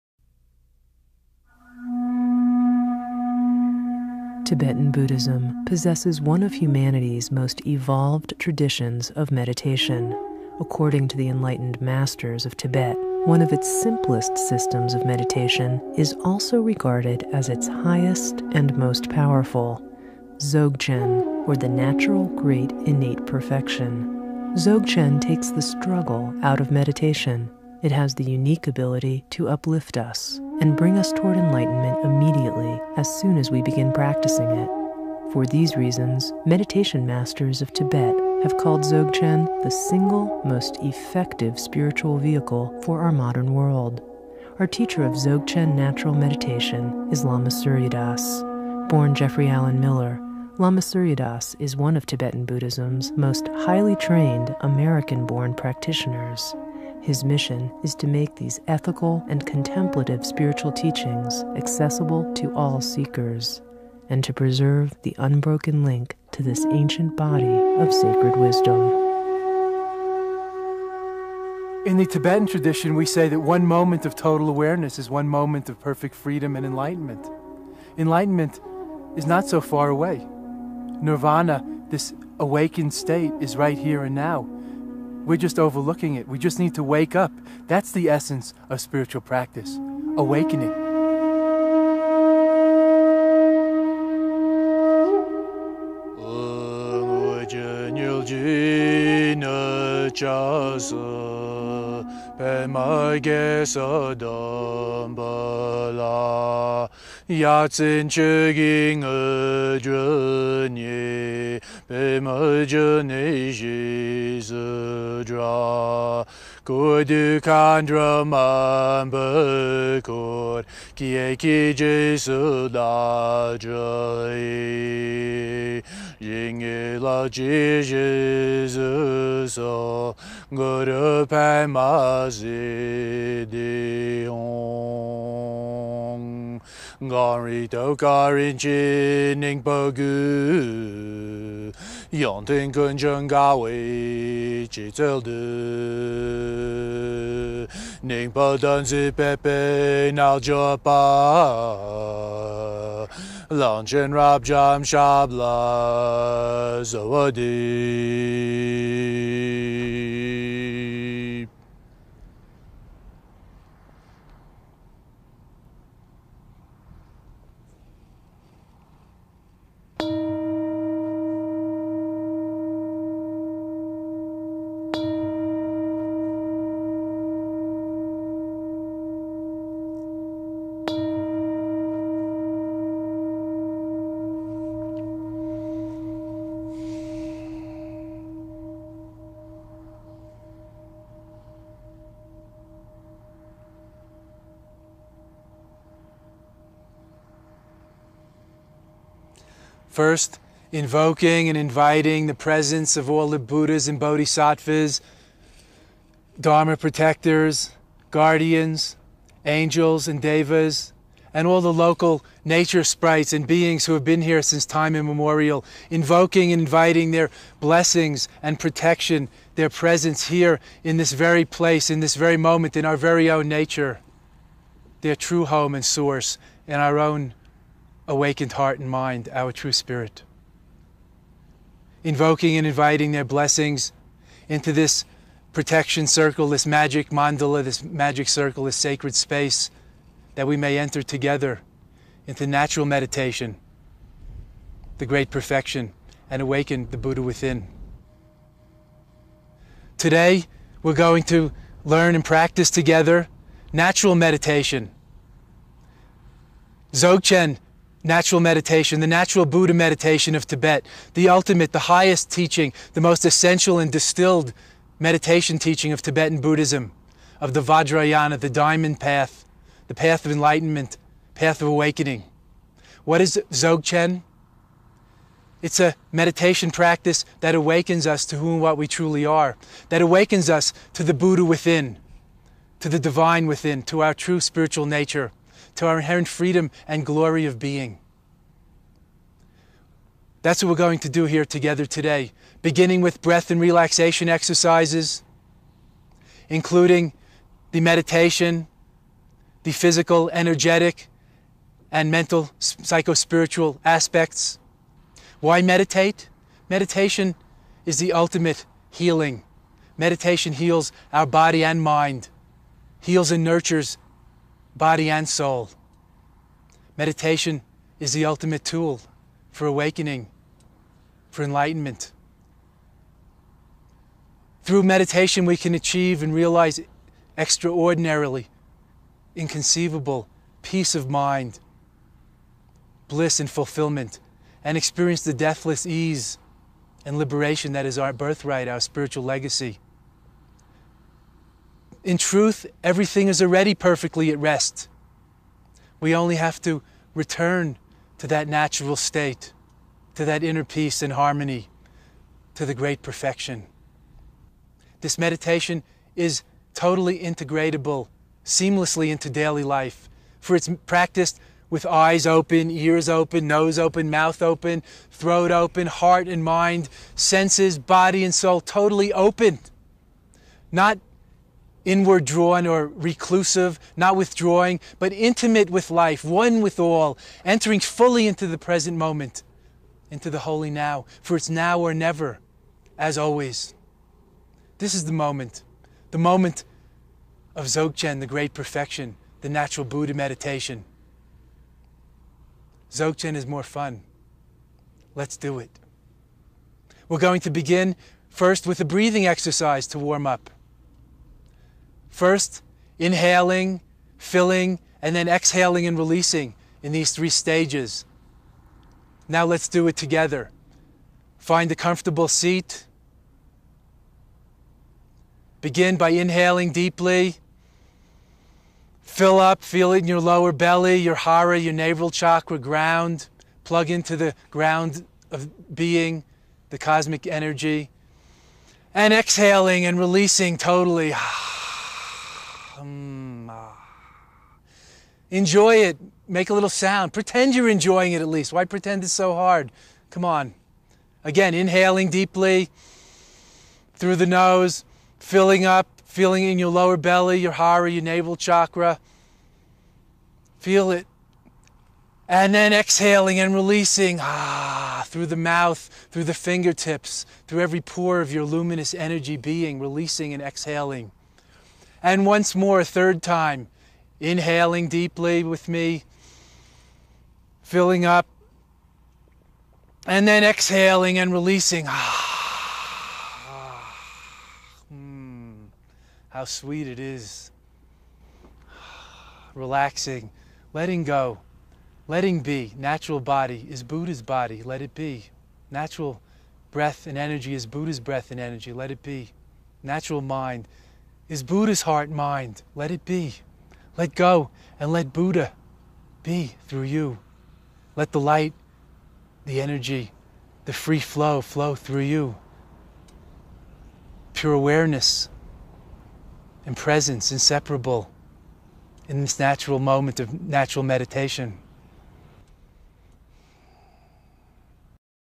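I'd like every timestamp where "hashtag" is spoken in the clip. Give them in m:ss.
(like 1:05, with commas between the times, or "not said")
not said.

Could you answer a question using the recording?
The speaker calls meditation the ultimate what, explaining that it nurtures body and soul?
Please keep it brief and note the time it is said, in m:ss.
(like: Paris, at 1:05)
healing, at 5:07.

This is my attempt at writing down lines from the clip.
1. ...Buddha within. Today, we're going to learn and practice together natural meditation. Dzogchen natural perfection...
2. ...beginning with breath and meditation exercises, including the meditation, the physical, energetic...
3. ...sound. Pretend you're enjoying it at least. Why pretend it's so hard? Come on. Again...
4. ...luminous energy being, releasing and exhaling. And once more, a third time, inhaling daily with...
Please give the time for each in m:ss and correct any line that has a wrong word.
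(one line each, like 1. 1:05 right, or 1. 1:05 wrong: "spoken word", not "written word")
1. 4:06 wrong: "meditation", not "perfection"
2. 4:52 wrong: "relaxation", not "meditation"
3. 7:16 right
4. 7:38 wrong: "deeply", not "daily".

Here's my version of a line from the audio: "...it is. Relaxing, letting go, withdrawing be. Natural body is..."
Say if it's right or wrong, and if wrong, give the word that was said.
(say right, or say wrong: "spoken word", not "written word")
wrong: "letting", not "withdrawing".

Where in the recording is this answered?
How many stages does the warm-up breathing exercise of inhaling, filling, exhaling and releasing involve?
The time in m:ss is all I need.
6:47.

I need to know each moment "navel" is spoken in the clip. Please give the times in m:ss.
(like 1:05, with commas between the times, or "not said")
7:01, 7:28.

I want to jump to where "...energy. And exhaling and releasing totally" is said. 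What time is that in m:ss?
7:07.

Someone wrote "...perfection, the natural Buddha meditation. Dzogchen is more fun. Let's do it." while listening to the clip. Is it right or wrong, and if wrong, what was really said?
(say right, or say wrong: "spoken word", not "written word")
right.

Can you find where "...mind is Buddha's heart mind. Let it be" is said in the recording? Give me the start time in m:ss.
8:10.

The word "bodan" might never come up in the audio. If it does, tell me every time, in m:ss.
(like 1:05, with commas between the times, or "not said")
2:28.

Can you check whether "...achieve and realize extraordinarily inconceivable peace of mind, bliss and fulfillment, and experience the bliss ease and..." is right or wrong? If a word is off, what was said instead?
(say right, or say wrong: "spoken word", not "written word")
wrong: "deathless", not "bliss".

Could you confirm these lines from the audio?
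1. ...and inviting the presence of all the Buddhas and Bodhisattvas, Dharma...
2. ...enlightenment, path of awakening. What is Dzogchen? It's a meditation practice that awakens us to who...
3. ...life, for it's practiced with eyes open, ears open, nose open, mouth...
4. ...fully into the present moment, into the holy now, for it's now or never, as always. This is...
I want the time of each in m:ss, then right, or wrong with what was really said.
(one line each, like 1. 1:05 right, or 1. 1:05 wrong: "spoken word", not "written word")
1. 3:21 right
2. 4:30 right
3. 5:59 right
4. 6:17 right.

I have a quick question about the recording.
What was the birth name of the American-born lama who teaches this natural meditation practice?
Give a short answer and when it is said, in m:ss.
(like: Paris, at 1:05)
Jeffrey Allen Miller, at 0:49.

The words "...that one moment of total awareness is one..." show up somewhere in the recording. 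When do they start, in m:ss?
1:13.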